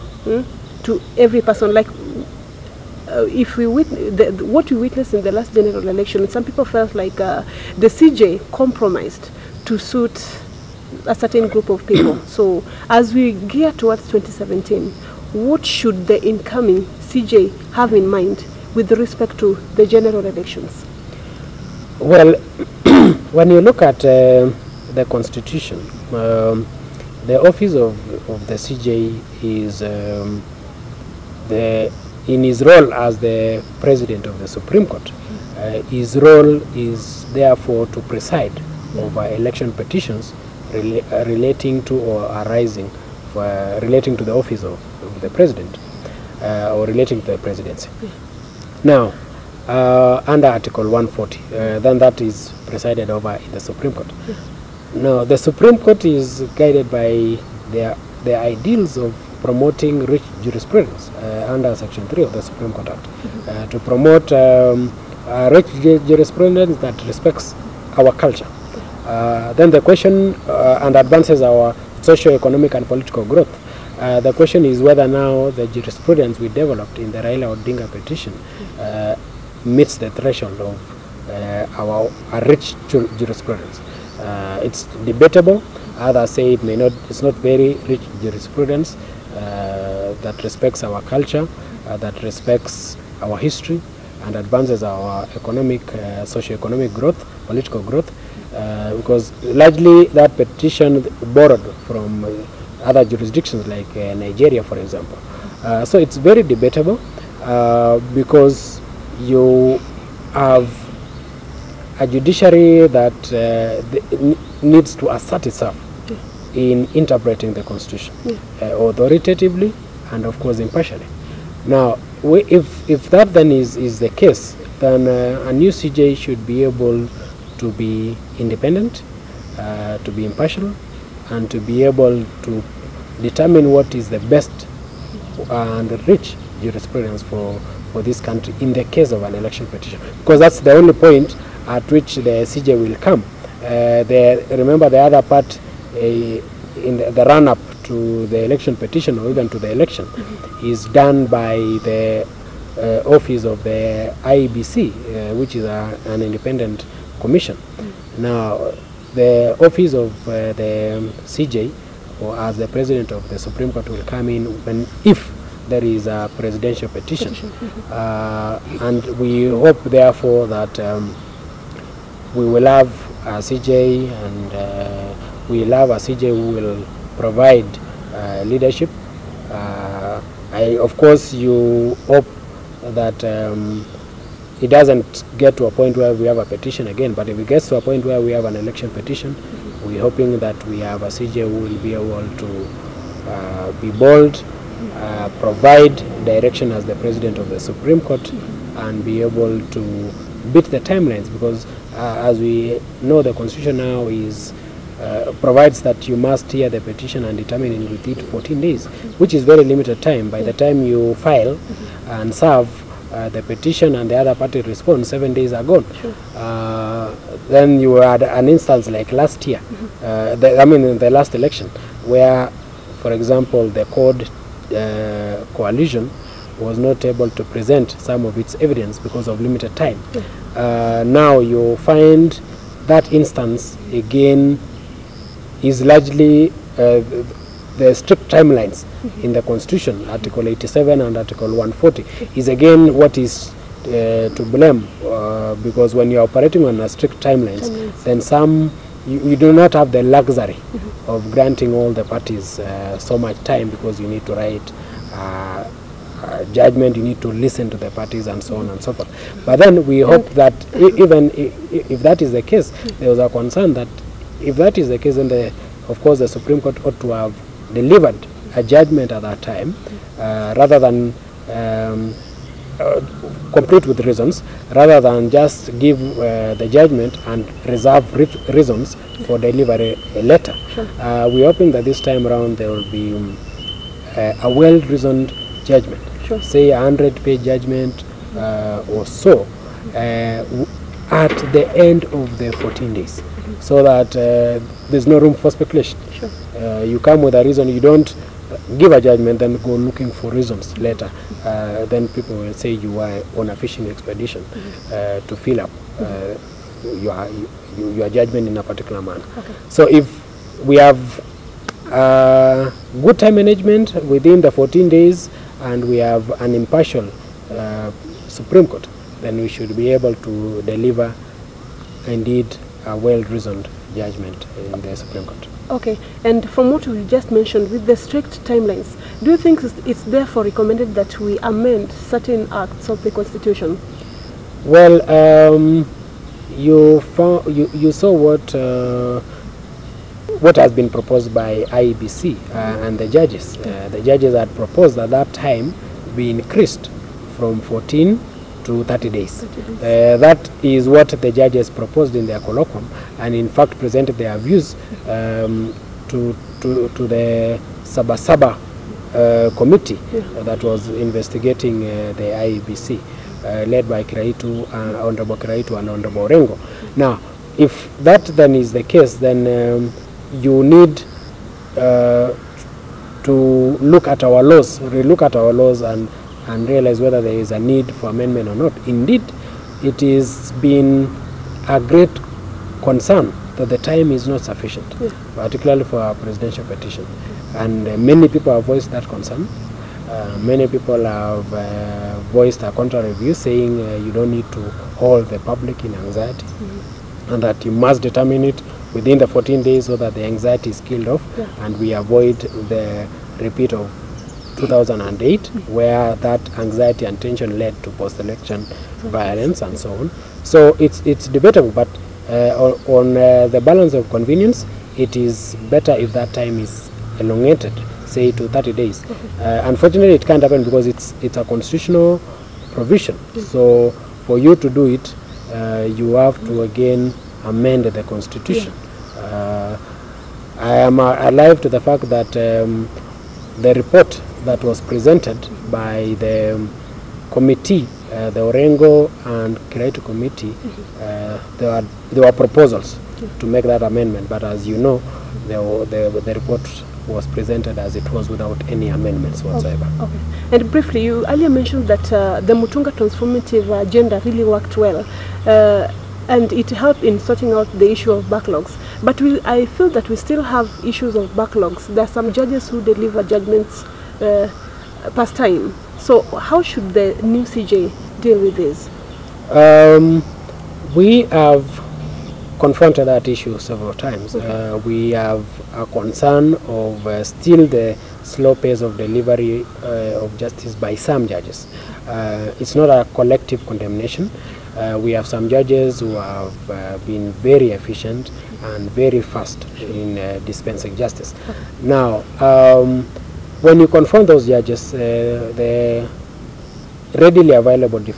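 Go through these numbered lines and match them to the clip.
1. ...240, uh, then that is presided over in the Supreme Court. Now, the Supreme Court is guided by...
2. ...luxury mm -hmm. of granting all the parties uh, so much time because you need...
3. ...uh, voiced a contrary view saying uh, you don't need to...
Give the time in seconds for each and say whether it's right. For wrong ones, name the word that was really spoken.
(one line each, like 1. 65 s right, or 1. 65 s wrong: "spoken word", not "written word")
1. 50 s wrong: "140", not "240"
2. 250 s right
3. 391 s right.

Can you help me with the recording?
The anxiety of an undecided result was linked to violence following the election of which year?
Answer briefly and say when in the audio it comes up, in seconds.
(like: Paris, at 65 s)
2008, at 404 s.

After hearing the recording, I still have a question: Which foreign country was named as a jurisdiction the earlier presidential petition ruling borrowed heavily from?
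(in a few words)
Nigeria.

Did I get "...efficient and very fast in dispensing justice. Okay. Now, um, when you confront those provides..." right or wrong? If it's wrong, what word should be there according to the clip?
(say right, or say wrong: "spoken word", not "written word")
wrong: "judges", not "provides".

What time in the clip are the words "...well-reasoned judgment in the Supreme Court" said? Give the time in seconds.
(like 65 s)
322 s.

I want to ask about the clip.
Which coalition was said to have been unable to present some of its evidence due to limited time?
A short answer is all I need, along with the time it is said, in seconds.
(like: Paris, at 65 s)
CORD, at 223 s.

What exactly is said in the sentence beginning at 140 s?
Because that's the only point at which the CJ will come.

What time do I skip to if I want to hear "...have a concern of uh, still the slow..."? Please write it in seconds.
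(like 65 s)
475 s.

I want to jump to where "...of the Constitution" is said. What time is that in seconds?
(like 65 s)
332 s.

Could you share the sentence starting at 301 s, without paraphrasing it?
Uh, then people will say you are on a fishing expedition mm-hmm.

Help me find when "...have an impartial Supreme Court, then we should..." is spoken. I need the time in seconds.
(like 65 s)
315 s.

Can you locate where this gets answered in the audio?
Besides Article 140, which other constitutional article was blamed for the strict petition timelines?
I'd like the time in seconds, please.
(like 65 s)
240 s.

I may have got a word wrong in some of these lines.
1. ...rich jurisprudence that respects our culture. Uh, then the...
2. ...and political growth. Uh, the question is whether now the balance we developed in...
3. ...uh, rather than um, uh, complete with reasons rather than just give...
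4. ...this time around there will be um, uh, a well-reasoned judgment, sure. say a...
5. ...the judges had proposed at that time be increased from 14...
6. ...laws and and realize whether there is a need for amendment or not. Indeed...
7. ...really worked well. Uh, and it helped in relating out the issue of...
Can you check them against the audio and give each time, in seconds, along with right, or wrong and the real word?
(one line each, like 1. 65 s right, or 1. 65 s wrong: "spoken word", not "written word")
1. 65 s right
2. 72 s wrong: "jurisprudence", not "balance"
3. 270 s right
4. 281 s right
5. 343 s right
6. 375 s right
7. 454 s wrong: "sorting", not "relating".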